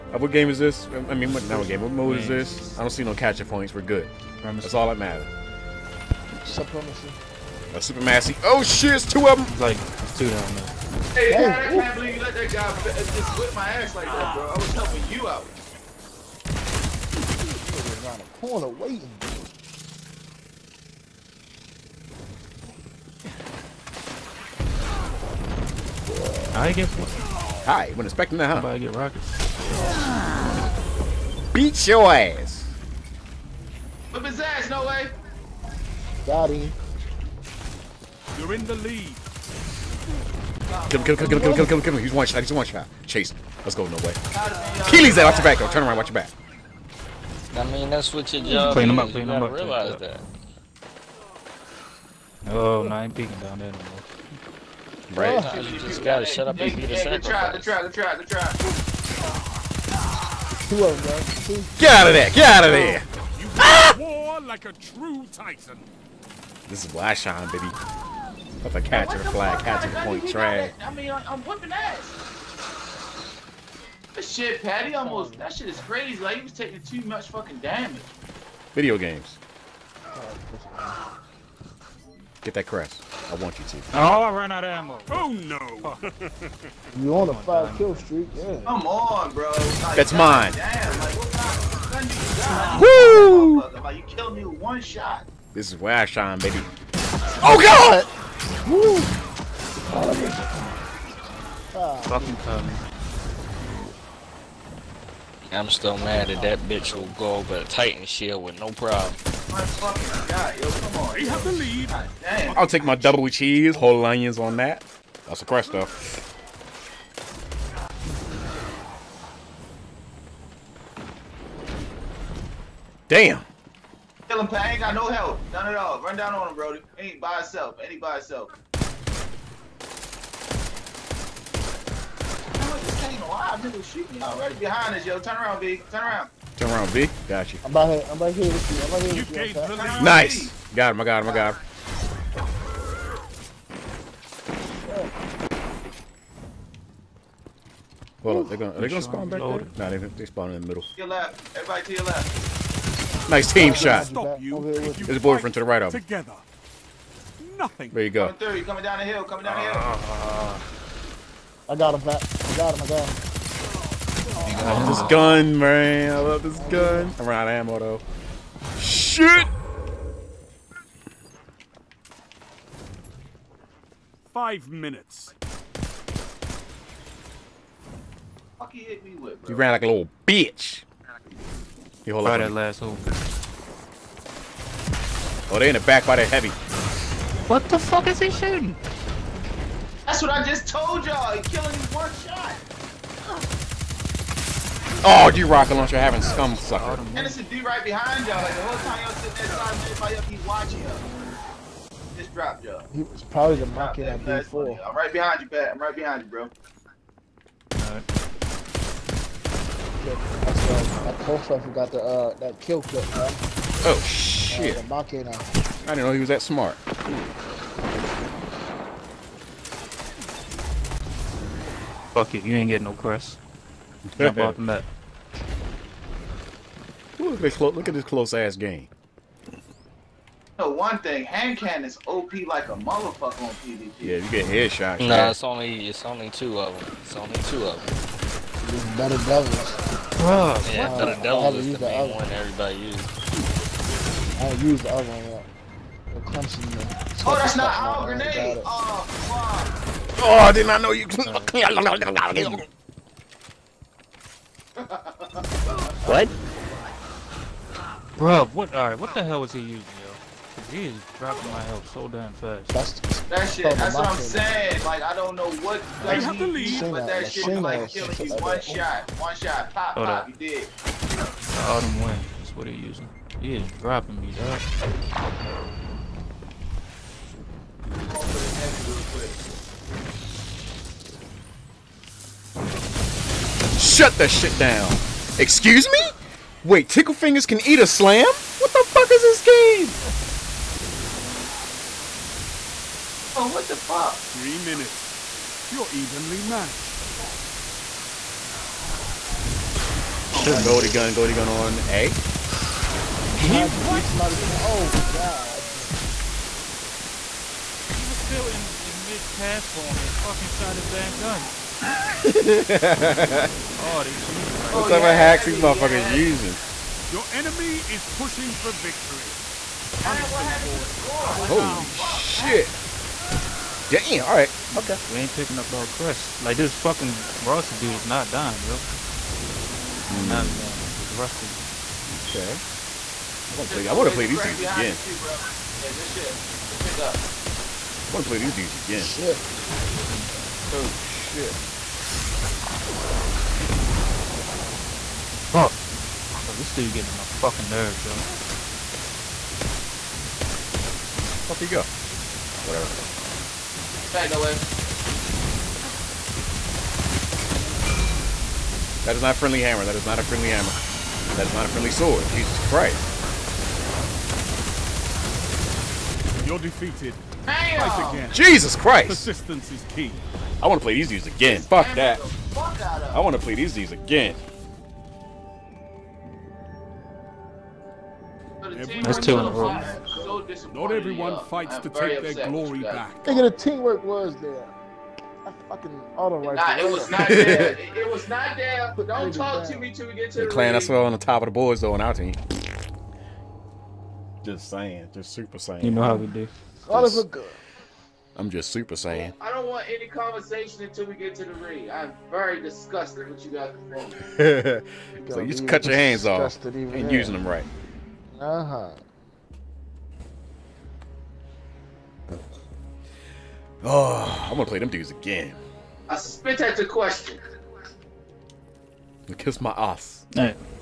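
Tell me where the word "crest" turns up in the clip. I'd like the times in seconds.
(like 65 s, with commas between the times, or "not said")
82 s, 325 s.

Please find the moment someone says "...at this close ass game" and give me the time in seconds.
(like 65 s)
227 s.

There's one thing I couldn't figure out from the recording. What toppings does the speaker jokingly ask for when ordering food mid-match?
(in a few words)
double cheese, whole onions.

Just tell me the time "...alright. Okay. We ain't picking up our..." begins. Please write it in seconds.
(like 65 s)
324 s.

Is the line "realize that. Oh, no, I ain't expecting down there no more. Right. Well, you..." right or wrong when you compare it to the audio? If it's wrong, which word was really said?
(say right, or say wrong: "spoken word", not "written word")
wrong: "peeking", not "expecting".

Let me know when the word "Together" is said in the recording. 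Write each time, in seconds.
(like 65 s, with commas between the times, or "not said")
156 s.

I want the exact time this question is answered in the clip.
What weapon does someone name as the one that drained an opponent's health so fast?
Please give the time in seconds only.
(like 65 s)
271 s.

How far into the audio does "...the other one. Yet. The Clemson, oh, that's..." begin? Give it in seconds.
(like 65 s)
244 s.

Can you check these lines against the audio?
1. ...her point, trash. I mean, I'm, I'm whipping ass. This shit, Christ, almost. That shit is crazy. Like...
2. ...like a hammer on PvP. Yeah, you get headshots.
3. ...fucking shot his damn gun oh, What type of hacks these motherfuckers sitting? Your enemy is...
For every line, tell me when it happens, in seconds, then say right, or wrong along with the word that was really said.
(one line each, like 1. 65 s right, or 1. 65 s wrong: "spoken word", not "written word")
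1. 69 s wrong: "Patty", not "Christ"
2. 232 s wrong: "motherfucker", not "hammer"
3. 310 s wrong: "using", not "sitting".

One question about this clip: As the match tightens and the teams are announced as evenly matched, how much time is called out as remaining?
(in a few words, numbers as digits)
3 minutes.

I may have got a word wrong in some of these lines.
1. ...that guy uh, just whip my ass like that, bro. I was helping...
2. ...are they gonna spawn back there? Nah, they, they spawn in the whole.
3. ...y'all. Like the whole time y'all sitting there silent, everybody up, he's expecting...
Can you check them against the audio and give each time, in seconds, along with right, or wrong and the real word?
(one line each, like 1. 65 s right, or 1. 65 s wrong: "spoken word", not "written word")
1. 12 s right
2. 148 s wrong: "middle", not "whole"
3. 198 s wrong: "watching", not "expecting".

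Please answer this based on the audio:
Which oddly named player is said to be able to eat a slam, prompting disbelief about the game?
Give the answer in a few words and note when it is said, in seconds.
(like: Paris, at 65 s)
Tickle Fingers, at 286 s.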